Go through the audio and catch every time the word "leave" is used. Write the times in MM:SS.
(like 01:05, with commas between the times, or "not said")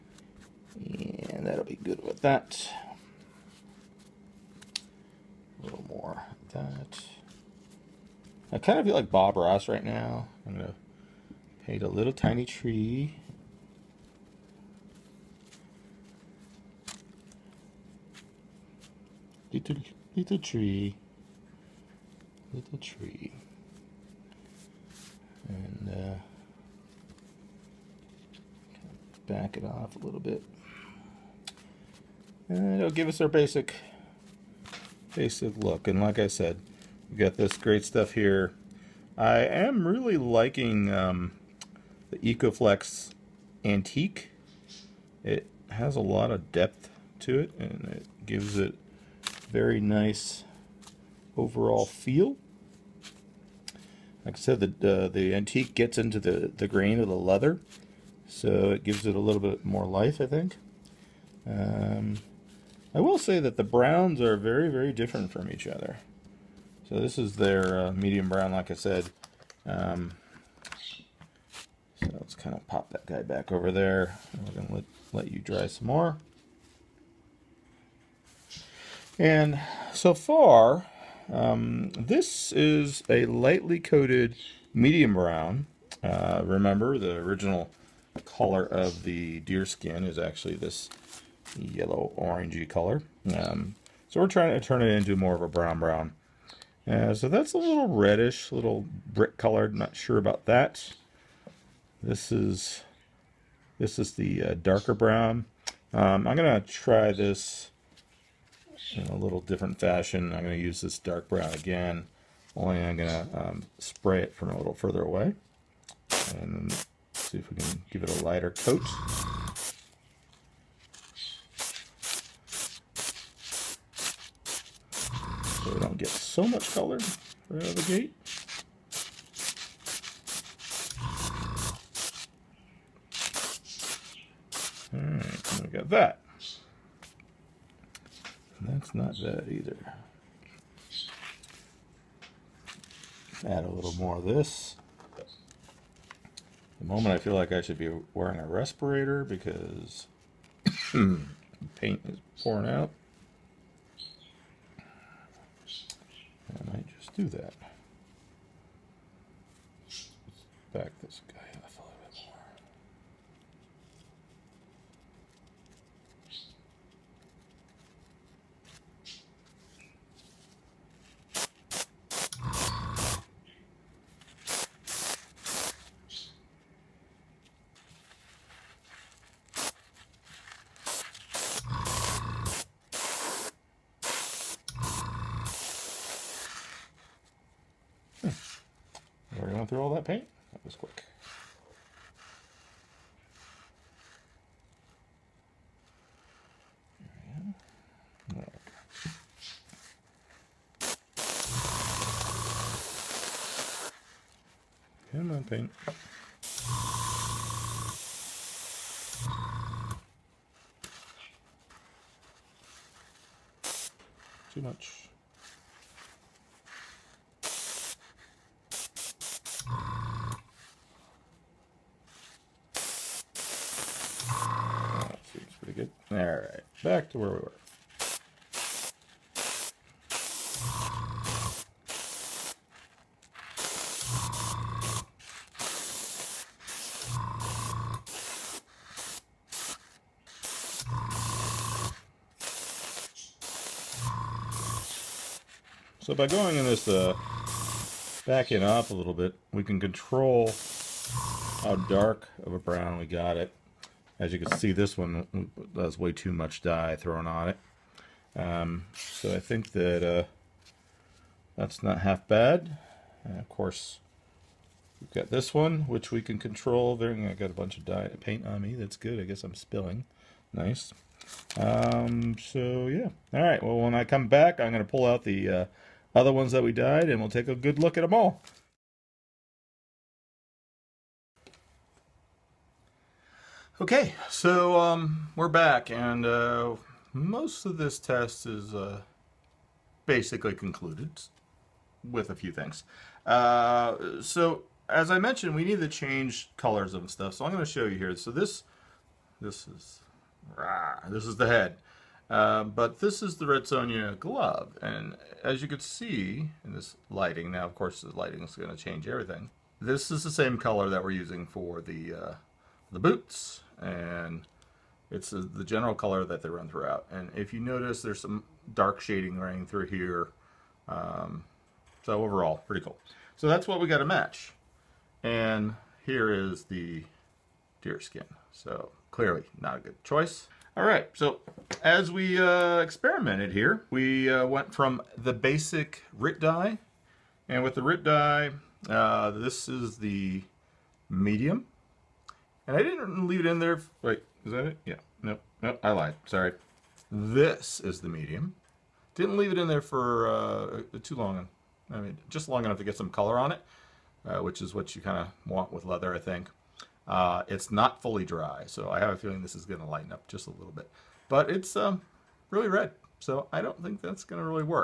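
05:43, 05:49.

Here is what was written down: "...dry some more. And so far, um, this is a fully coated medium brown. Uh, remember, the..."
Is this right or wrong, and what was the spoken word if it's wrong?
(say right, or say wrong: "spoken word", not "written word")
wrong: "lightly", not "fully".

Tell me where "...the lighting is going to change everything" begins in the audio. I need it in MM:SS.
05:08.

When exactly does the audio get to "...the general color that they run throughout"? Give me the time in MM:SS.
05:15.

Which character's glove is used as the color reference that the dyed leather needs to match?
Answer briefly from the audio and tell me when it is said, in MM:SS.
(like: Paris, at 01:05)
Red Sonja, at 05:03.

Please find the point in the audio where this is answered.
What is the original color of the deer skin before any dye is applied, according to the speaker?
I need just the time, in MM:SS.
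01:31.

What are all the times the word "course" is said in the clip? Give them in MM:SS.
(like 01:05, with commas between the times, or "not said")
04:23, 05:07.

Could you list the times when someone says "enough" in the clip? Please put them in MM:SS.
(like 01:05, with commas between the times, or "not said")
05:52.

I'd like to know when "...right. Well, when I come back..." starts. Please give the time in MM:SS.
04:33.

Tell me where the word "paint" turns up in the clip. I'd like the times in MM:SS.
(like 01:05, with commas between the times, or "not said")
00:11, 02:31, 03:10, 03:25, 04:28.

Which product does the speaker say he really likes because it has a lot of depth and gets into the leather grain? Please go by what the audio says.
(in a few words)
EcoFlex Antique.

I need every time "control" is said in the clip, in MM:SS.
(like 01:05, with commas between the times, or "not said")
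04:09, 04:26.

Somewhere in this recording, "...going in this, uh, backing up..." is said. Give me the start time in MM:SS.
04:06.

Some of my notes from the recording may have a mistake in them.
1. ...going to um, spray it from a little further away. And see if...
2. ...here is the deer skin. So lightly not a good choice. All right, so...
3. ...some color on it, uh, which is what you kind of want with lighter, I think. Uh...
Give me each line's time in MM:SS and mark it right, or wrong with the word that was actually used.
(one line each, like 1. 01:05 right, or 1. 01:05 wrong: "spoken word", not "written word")
1. 01:52 right
2. 05:26 wrong: "clearly", not "lightly"
3. 05:52 wrong: "leather", not "lighter".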